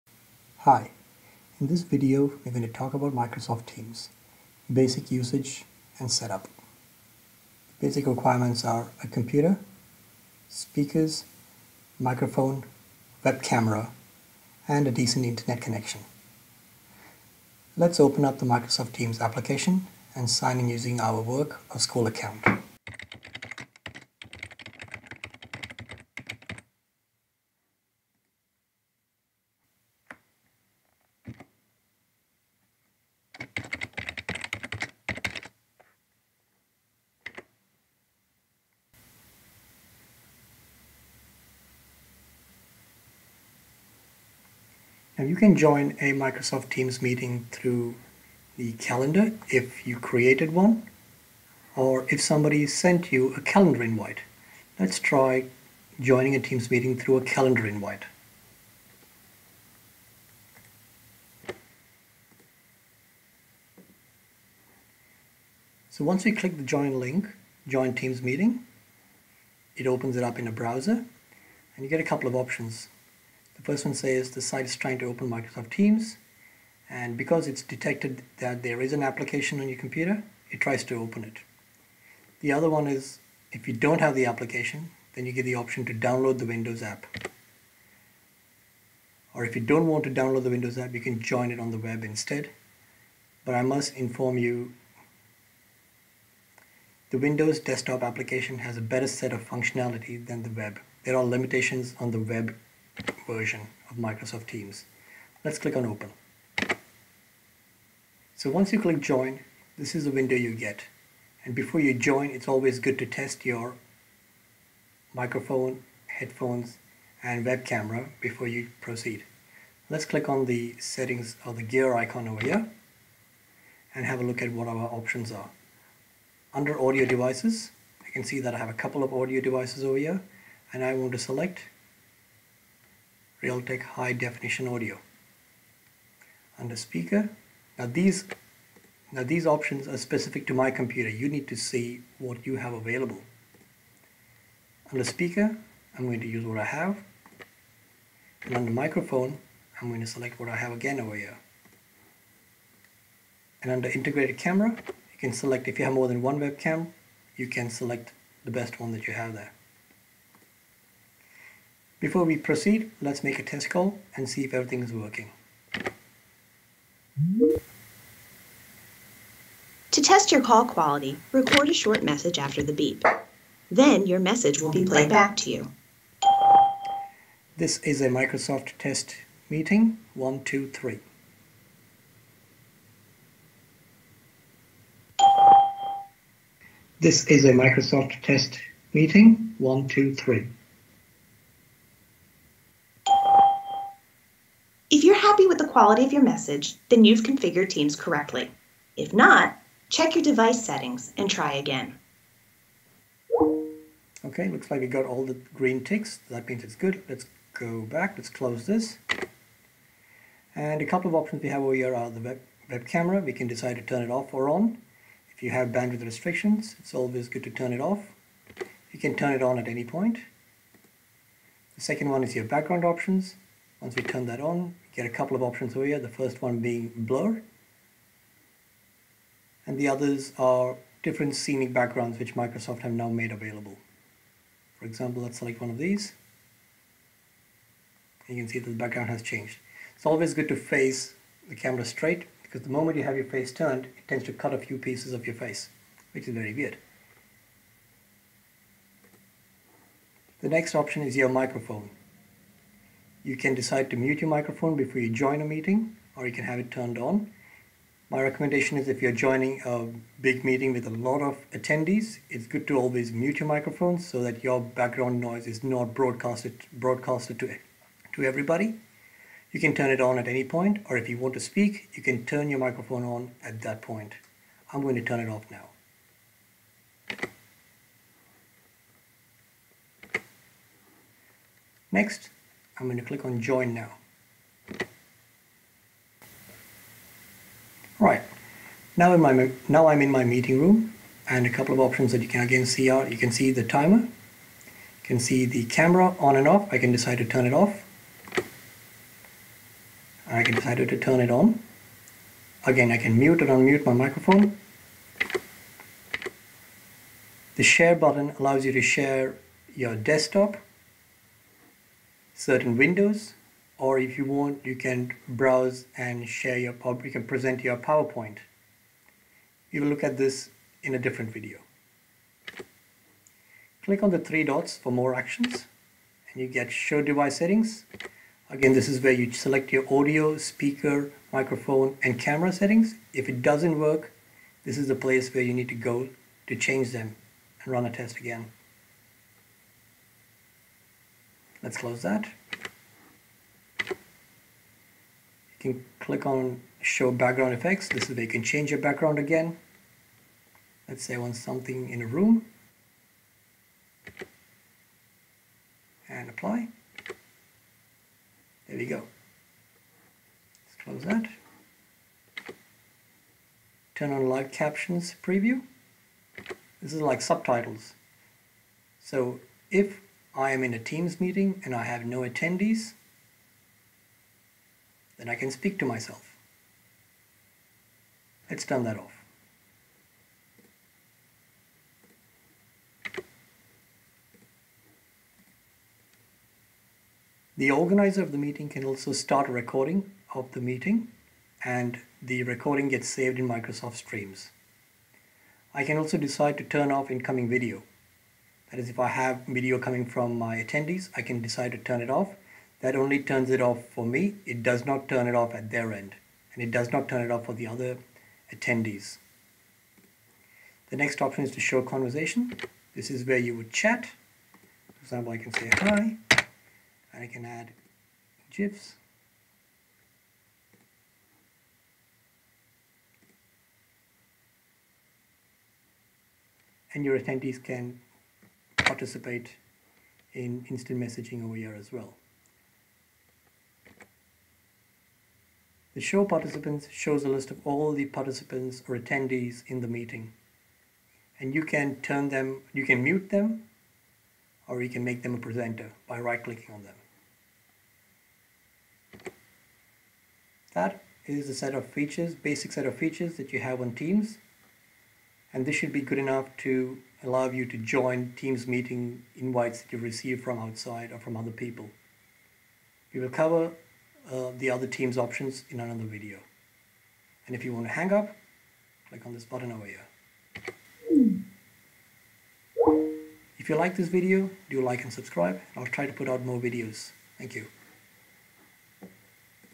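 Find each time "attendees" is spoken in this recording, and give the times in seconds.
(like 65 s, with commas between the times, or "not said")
261 s, 372 s, 400 s, 408 s, 427 s, 438 s.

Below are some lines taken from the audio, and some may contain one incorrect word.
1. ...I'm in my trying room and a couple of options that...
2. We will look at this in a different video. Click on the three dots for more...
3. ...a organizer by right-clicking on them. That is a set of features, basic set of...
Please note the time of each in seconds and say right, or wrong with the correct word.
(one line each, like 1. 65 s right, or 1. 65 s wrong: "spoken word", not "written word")
1. 289 s wrong: "meeting", not "trying"
2. 319 s right
3. 445 s wrong: "presenter", not "organizer".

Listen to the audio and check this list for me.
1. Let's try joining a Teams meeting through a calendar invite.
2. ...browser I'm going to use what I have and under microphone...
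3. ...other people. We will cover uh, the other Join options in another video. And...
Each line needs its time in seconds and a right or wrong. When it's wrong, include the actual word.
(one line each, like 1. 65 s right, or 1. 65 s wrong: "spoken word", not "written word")
1. 54 s right
2. 145 s wrong: "speaker", not "browser"
3. 461 s wrong: "Teams", not "Join".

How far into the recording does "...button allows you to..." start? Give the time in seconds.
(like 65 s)
307 s.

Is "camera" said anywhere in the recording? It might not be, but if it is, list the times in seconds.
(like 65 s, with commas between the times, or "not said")
13 s, 117 s, 154 s, 212 s, 241 s, 295 s, 332 s.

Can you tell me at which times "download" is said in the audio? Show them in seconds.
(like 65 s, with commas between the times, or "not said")
85 s, 90 s.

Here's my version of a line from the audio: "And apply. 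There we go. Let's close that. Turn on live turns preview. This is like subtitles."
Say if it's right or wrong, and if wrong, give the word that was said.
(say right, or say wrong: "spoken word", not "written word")
wrong: "captions", not "turns".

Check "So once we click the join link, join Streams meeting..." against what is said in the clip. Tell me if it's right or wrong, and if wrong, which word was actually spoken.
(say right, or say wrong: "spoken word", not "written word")
wrong: "Teams", not "Streams".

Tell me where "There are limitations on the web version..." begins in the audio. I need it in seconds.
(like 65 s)
101 s.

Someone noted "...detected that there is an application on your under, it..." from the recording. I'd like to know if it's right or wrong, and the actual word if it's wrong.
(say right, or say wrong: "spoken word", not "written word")
wrong: "computer", not "under".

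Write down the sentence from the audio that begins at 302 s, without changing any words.
Again, I can mute and unmute my microphone.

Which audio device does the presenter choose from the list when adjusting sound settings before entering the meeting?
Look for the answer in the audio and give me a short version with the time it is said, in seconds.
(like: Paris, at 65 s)
Realtek high definition audio, at 133 s.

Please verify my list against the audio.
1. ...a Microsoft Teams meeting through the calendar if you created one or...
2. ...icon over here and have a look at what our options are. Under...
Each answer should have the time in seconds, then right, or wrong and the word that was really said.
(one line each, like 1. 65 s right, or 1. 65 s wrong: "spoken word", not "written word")
1. 46 s right
2. 121 s right.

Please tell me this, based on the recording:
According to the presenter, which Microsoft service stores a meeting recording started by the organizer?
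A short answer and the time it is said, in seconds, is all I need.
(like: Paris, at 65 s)
Microsoft Streams, at 393 s.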